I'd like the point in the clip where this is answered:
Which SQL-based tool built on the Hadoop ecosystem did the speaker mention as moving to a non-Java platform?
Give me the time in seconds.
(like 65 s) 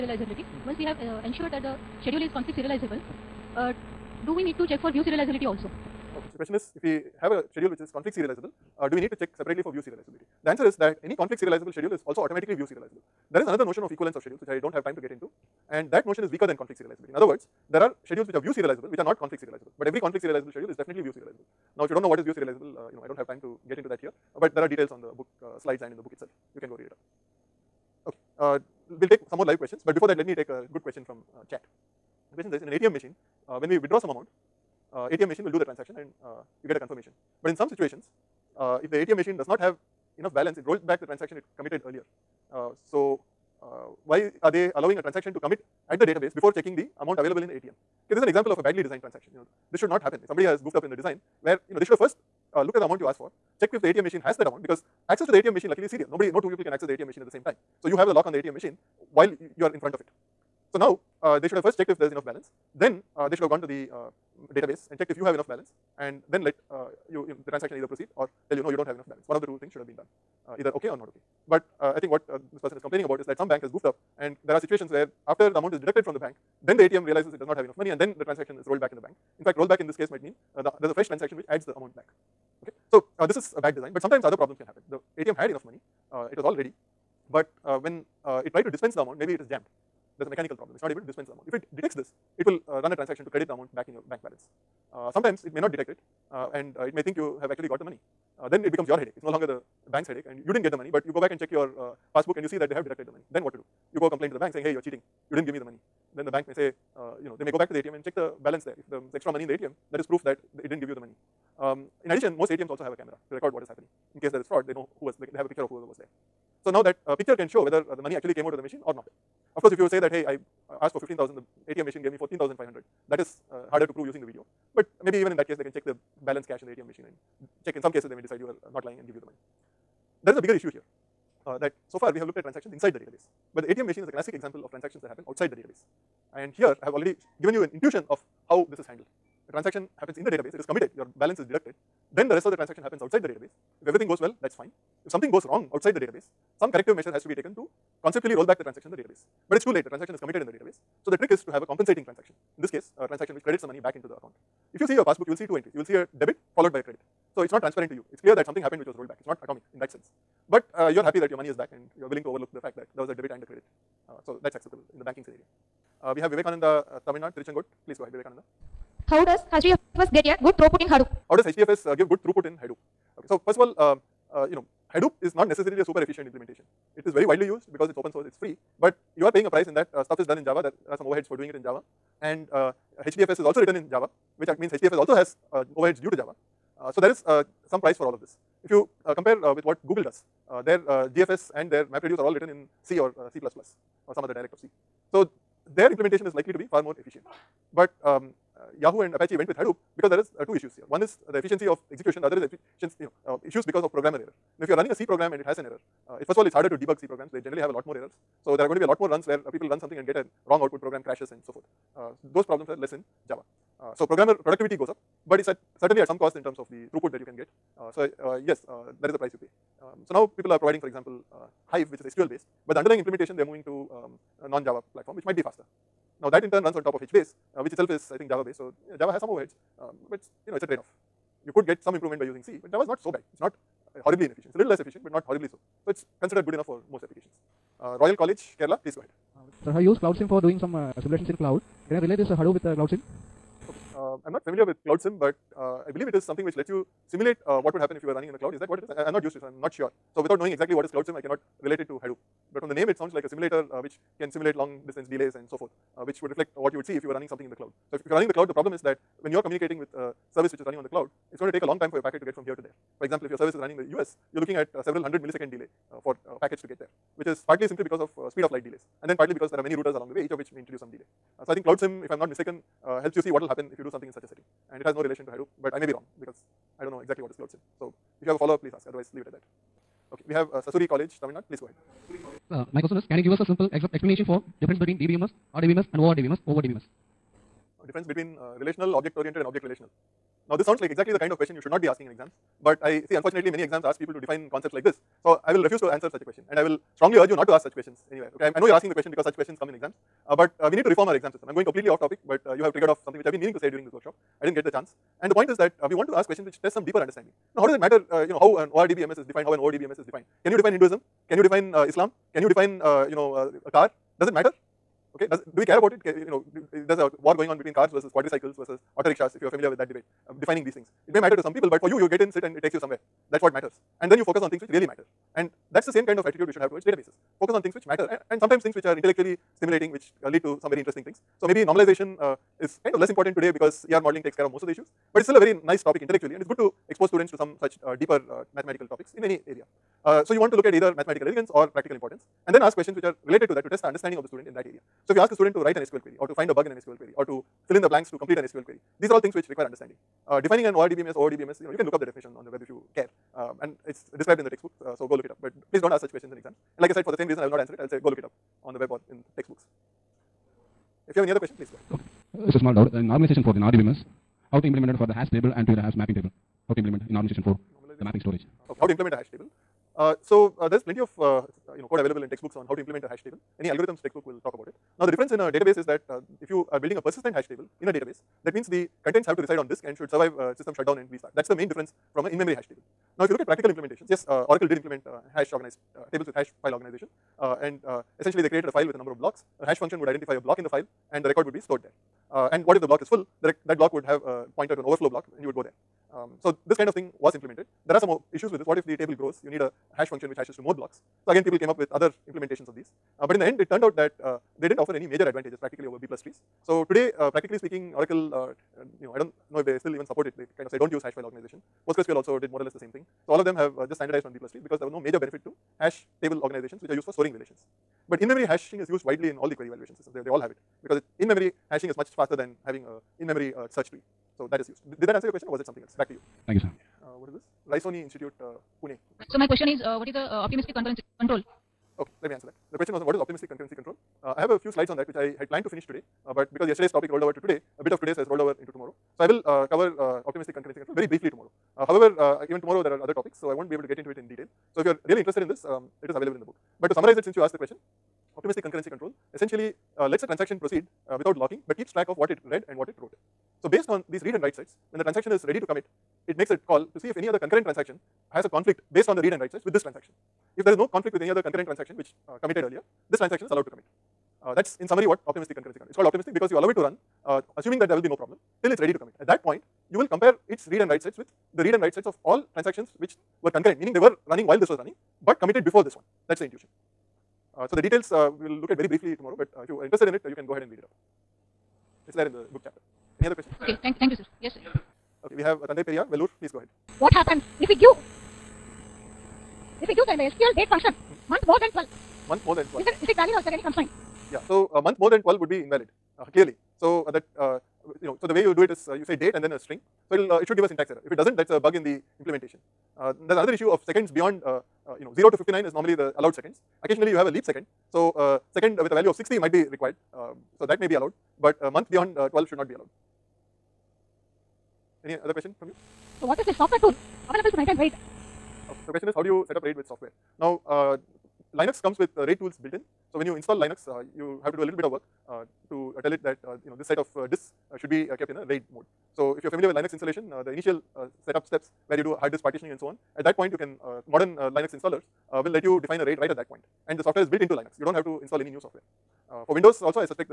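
221 s.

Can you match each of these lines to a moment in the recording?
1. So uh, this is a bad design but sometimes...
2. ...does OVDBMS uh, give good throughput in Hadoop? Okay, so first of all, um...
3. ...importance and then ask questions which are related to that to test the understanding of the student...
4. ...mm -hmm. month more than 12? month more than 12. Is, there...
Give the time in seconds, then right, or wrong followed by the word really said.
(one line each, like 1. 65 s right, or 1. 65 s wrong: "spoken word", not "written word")
1. 82 s right
2. 171 s wrong: "HDFS", not "OVDBMS"
3. 341 s right
4. 490 s right.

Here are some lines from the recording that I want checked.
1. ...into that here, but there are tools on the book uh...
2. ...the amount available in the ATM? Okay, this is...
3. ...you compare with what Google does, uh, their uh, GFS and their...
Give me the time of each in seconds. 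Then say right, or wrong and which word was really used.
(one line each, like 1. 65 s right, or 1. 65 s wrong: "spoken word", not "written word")
1. 23 s wrong: "details", not "tools"
2. 46 s right
3. 188 s right.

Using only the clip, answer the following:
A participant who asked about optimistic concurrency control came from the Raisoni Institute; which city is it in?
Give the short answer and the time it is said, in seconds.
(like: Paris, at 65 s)
Pune, at 428 s.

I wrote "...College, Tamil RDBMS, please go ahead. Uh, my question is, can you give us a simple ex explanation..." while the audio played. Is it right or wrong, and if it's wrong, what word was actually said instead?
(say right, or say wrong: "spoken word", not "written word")
wrong: "Nadu", not "RDBMS".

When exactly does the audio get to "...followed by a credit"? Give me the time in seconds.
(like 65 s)
156 s.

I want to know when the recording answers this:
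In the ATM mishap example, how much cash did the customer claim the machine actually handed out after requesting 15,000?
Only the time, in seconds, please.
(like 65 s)
122 s.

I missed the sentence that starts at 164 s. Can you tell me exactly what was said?
Uh, so that's acceptable in the banking scenario.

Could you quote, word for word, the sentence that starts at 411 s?
PostgreSQL also did more or less the same thing.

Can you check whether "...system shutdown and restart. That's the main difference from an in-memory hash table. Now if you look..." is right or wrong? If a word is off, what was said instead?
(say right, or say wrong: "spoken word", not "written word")
right.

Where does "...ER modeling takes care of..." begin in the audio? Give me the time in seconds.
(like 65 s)
333 s.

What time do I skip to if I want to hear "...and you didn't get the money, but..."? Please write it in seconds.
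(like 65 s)
100 s.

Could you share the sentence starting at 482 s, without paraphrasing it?
It's there in the book chapter.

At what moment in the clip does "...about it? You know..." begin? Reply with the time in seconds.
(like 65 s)
315 s.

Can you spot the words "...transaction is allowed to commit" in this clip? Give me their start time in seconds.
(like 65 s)
463 s.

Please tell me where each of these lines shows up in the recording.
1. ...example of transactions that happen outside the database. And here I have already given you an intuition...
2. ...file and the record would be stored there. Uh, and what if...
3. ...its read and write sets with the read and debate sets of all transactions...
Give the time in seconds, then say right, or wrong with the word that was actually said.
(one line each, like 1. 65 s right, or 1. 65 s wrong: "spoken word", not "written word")
1. 134 s right
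2. 390 s right
3. 470 s wrong: "write", not "debate".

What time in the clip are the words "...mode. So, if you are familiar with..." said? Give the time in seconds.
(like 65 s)
528 s.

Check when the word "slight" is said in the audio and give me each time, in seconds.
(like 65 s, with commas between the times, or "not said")
not said.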